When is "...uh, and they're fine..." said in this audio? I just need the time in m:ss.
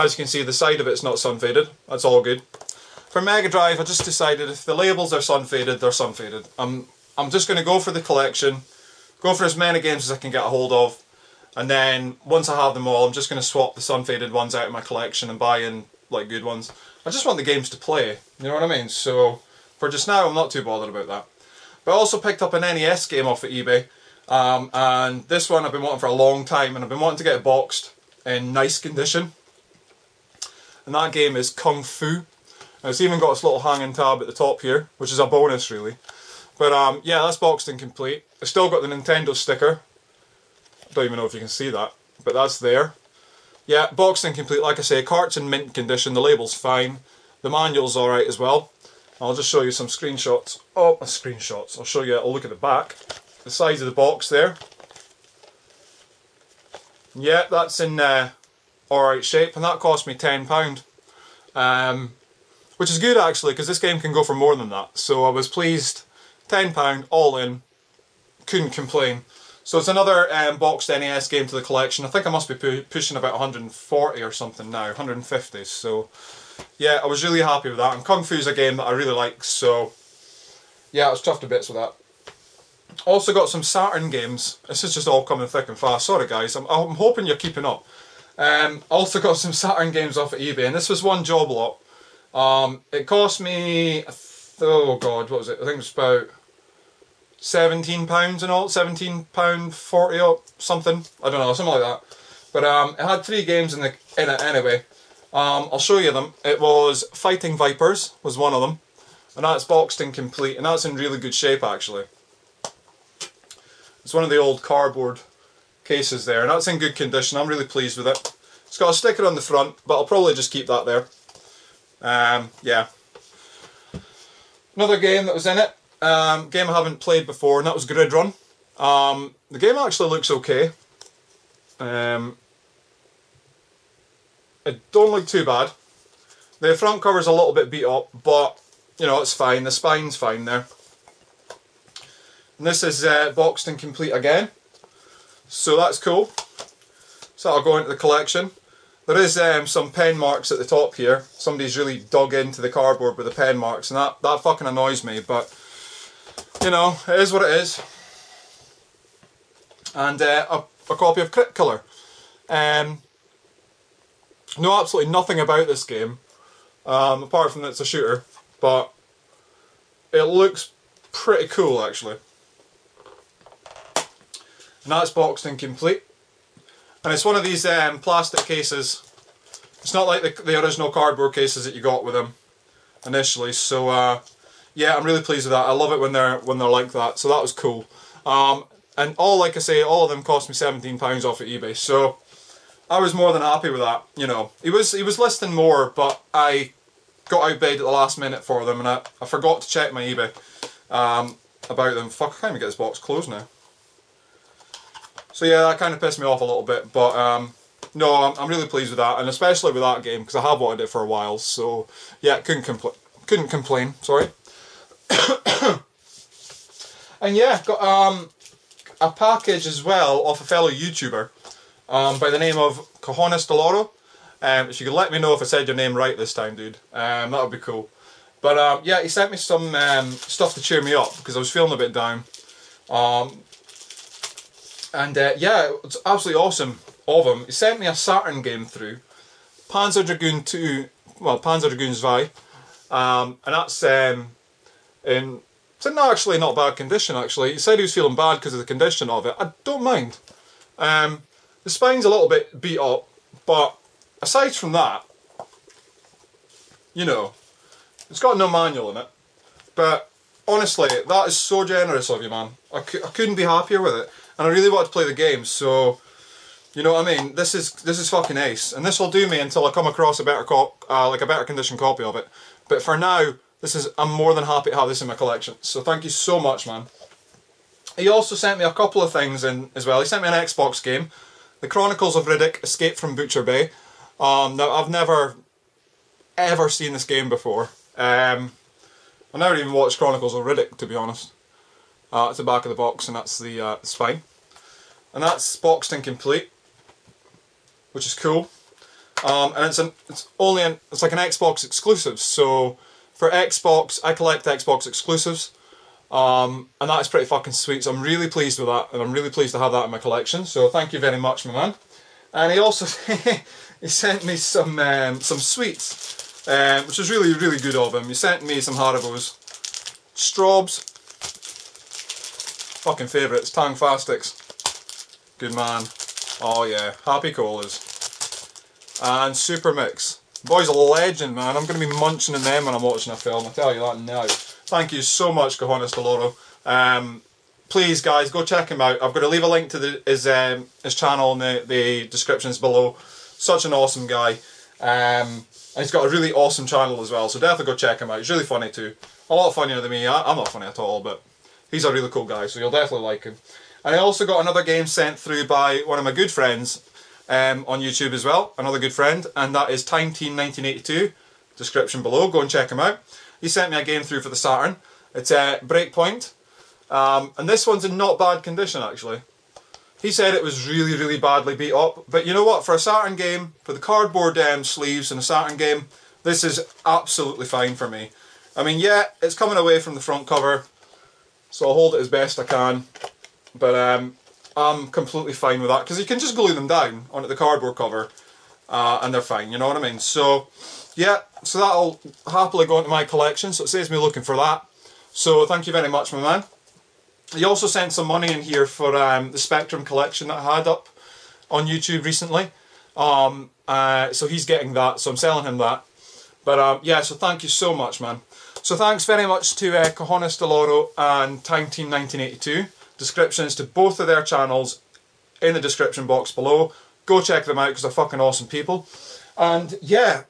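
6:28.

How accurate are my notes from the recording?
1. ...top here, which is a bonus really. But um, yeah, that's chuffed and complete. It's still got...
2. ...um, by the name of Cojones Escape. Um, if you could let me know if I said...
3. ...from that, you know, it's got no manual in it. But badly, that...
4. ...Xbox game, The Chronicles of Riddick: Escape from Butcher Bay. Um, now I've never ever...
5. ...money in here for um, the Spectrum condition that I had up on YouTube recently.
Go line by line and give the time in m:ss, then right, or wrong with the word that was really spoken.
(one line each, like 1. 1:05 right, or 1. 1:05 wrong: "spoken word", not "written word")
1. 0:34 wrong: "boxed", not "chuffed"
2. 3:41 wrong: "Deloro", not "Escape"
3. 4:14 wrong: "honestly", not "badly"
4. 4:40 right
5. 6:38 wrong: "collection", not "condition".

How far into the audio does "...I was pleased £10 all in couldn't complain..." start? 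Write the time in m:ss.
1:05.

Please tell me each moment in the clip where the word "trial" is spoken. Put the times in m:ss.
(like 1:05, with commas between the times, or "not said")
not said.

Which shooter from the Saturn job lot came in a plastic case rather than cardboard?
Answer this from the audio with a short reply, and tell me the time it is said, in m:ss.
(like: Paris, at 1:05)
Crypt Killer, at 2:41.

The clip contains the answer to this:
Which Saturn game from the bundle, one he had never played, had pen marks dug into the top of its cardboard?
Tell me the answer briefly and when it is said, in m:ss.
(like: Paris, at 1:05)
Grid Run, at 2:07.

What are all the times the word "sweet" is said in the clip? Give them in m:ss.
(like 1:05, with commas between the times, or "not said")
5:07, 5:15.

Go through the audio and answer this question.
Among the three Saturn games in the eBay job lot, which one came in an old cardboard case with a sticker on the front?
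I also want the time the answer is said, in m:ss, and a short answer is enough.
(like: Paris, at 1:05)
Fighting Vipers, at 1:47.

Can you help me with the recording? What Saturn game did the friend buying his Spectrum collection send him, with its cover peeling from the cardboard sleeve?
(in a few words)
Breakpoint.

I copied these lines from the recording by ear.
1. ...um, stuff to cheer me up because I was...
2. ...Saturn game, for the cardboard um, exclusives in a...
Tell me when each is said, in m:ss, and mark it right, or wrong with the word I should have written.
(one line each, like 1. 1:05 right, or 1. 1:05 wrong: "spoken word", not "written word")
1. 3:49 right
2. 6:12 wrong: "sleeves", not "exclusives".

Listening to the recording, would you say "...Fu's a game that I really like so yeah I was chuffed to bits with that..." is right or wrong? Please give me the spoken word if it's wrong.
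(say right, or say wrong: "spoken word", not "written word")
right.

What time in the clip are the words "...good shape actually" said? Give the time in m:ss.
1:51.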